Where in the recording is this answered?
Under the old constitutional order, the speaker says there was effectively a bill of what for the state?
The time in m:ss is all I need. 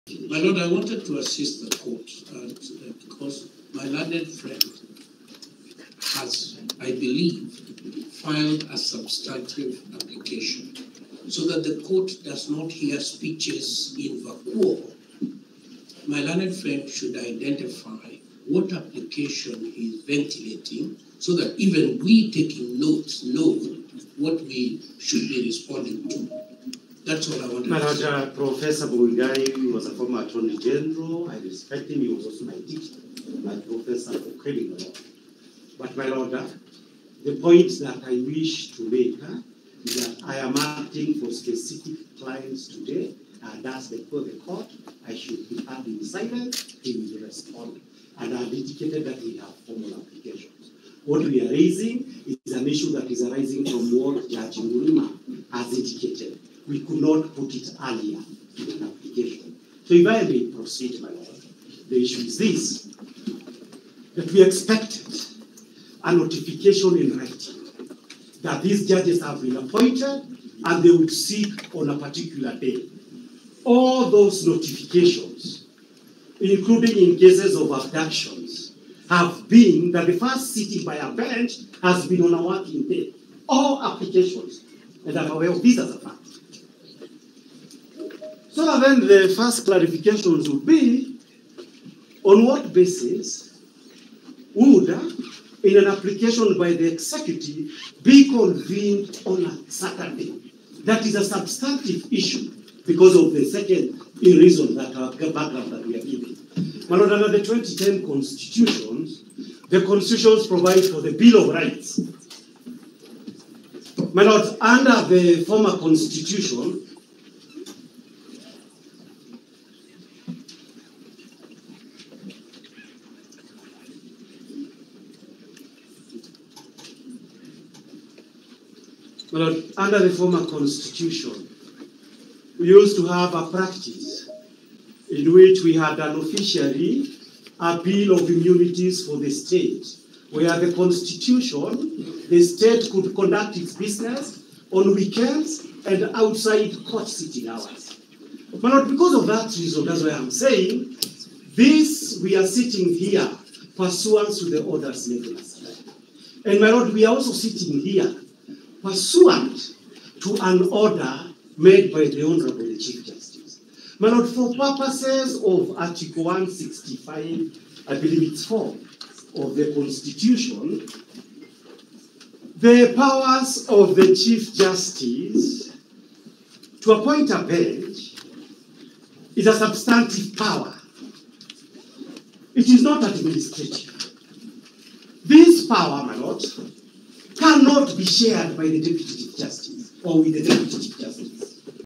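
2:17.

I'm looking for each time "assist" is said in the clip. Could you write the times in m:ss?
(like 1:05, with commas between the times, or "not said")
0:01.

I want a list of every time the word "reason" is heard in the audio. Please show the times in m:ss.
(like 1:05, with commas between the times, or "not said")
1:44, 2:29.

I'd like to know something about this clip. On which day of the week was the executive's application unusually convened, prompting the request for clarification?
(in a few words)
Saturday.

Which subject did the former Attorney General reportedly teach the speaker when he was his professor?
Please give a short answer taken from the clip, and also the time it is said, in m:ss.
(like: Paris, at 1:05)
Criminal law, at 0:34.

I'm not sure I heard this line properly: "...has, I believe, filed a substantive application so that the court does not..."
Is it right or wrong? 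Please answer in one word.
right.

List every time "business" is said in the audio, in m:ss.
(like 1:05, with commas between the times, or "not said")
2:23.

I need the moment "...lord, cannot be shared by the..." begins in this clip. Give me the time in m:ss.
3:06.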